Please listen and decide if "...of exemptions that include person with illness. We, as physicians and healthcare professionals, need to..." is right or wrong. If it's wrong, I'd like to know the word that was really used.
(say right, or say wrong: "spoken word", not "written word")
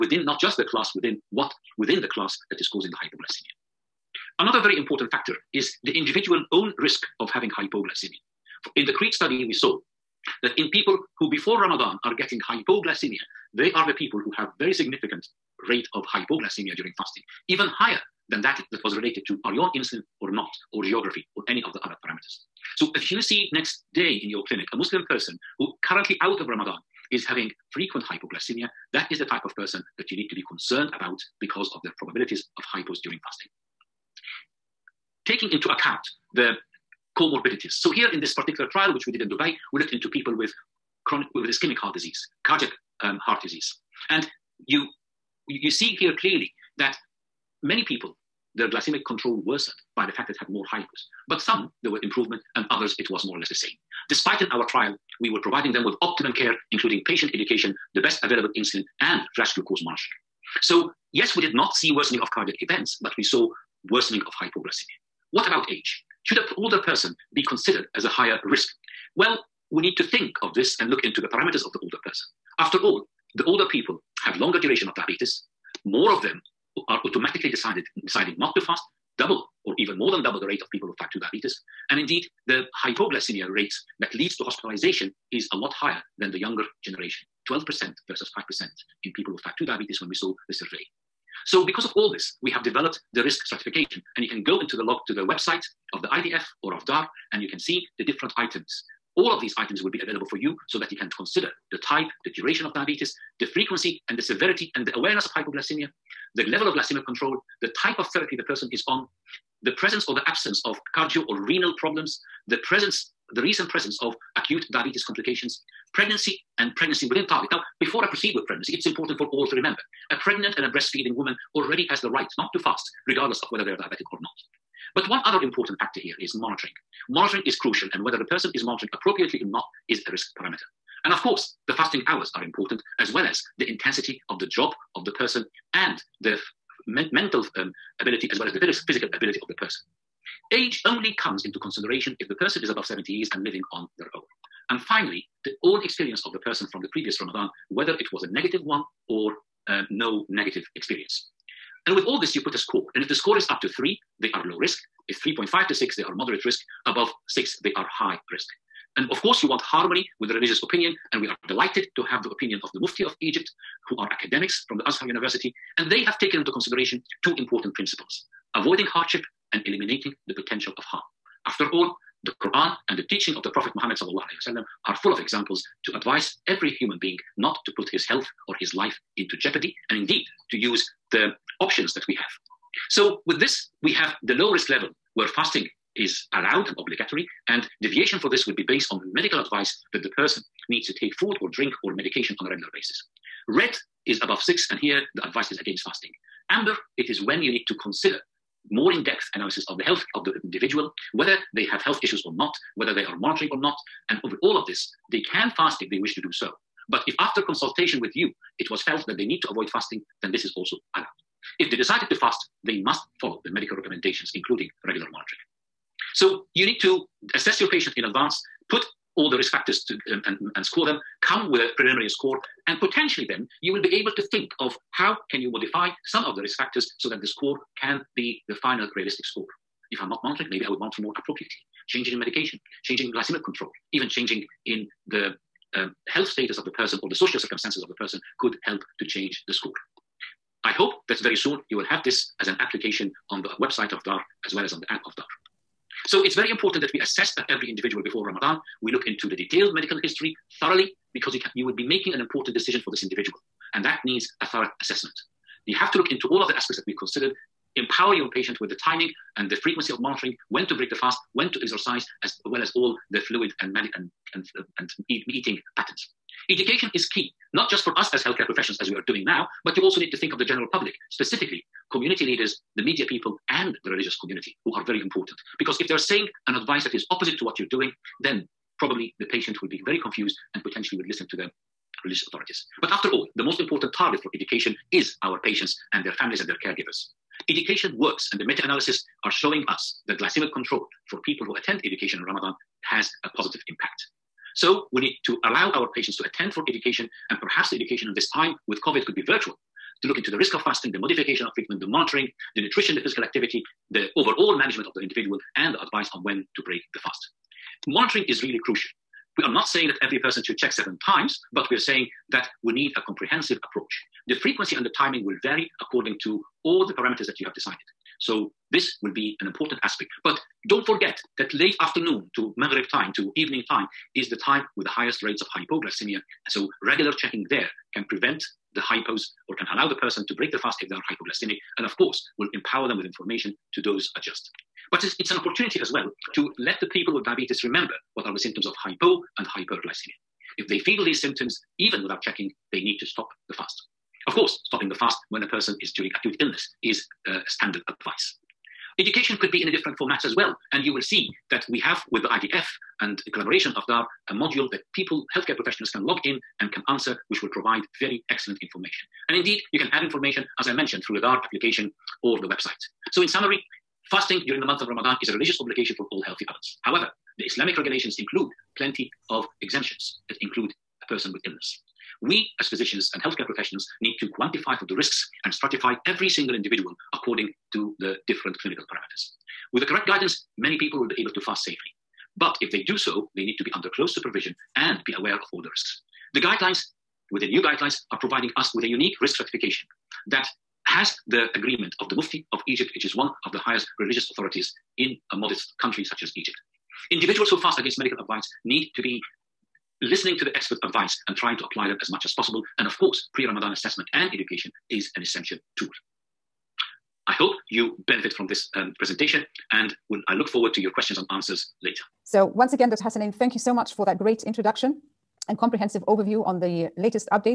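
right.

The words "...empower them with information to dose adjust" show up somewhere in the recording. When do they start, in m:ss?
5:32.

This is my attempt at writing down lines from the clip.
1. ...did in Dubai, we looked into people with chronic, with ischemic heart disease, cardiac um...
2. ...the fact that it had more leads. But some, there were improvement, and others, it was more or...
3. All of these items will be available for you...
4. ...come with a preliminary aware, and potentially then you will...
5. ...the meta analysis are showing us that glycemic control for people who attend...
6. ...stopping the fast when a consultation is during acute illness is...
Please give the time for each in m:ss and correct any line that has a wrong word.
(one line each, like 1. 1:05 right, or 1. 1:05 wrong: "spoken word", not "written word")
1. 0:39 right
2. 0:50 wrong: "hybrids", not "leads"
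3. 1:39 right
4. 3:41 wrong: "score", not "aware"
5. 4:48 right
6. 5:44 wrong: "person", not "consultation".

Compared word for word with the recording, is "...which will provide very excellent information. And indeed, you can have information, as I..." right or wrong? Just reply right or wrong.
right.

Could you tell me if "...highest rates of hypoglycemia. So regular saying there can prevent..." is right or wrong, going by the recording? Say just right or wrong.
wrong.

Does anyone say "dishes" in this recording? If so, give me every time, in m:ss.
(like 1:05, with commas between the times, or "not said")
not said.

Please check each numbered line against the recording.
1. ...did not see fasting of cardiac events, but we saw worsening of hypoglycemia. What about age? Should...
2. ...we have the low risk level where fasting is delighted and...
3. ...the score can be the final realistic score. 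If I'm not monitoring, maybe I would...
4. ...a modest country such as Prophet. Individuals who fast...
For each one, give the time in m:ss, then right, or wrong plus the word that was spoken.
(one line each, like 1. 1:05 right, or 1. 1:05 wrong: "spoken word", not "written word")
1. 1:01 wrong: "worsening", not "fasting"
2. 3:03 wrong: "allowed", not "delighted"
3. 3:47 right
4. 6:35 wrong: "Egypt", not "Prophet".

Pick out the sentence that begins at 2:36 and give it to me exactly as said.
Above 6, they are high risk.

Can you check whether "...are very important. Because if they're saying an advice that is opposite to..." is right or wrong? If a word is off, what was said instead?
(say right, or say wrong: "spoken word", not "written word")
right.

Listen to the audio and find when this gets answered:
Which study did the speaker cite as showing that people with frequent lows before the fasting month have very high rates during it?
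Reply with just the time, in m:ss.
0:08.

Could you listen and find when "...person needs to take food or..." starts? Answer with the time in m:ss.
3:10.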